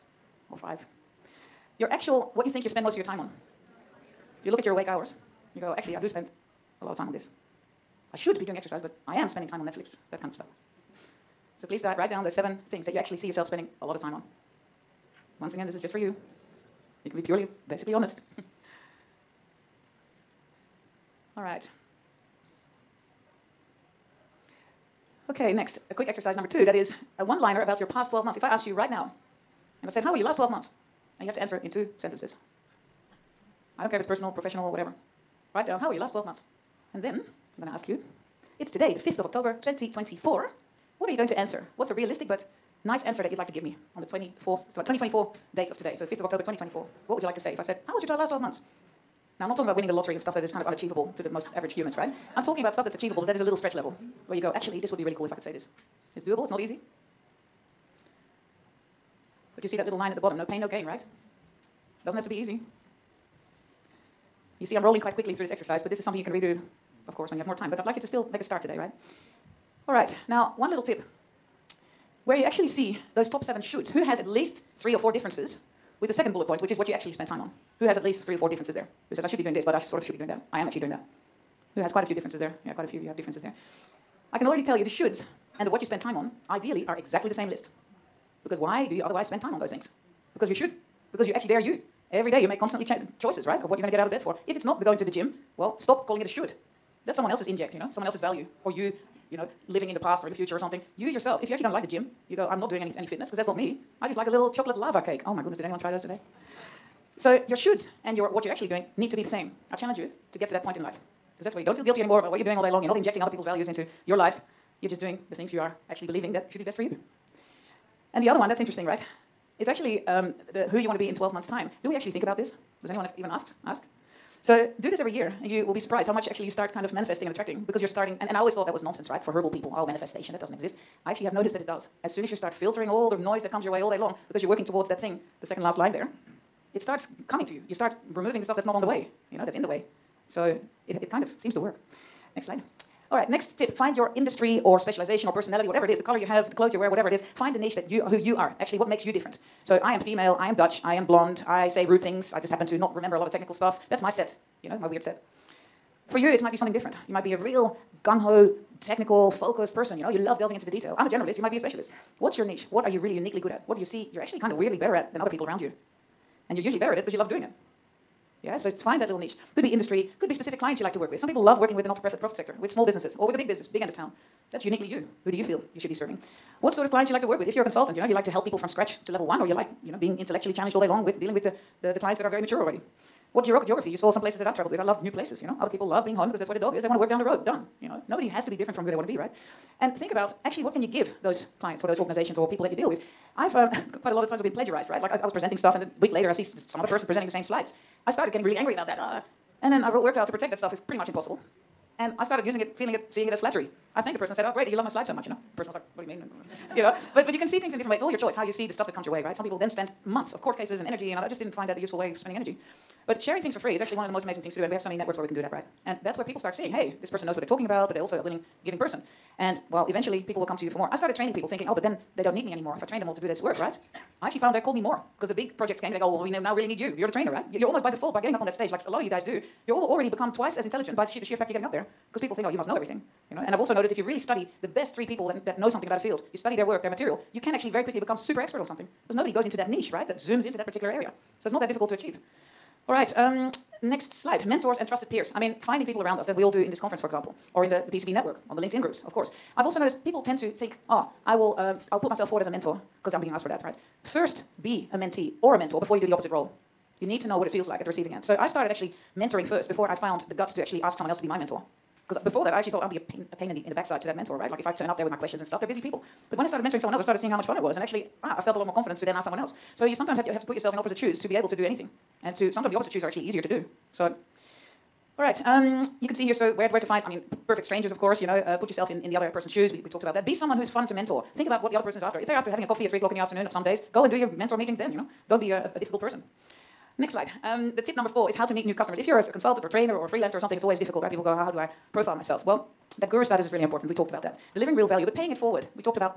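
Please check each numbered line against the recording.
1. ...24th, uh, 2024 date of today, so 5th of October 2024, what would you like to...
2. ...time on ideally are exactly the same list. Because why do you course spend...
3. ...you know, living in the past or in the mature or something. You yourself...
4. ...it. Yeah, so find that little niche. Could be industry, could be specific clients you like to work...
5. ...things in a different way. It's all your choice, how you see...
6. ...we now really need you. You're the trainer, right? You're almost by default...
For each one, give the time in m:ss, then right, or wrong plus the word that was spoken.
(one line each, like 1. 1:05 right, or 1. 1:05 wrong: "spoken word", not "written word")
1. 0:44 right
2. 1:26 wrong: "otherwise", not "course"
3. 1:39 wrong: "future", not "mature"
4. 2:47 right
5. 3:27 right
6. 3:46 right.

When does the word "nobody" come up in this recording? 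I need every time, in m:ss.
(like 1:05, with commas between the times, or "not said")
3:08, 3:59.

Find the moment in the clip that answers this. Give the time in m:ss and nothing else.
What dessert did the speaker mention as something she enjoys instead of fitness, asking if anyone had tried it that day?
1:44.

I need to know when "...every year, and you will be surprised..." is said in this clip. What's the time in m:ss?
2:04.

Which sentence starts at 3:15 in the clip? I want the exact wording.
Like I, I, was presenting stuff, and then a week later I see some other person presenting the same slides.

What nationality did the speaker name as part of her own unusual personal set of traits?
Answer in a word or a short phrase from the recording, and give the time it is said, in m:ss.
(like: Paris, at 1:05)
Dutch, at 2:30.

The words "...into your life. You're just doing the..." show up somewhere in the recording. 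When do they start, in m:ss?
1:53.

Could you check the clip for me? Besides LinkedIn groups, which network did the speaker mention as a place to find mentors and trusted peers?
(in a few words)
PECB.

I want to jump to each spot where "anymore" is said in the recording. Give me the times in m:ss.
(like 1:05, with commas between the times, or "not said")
1:52, 3:42.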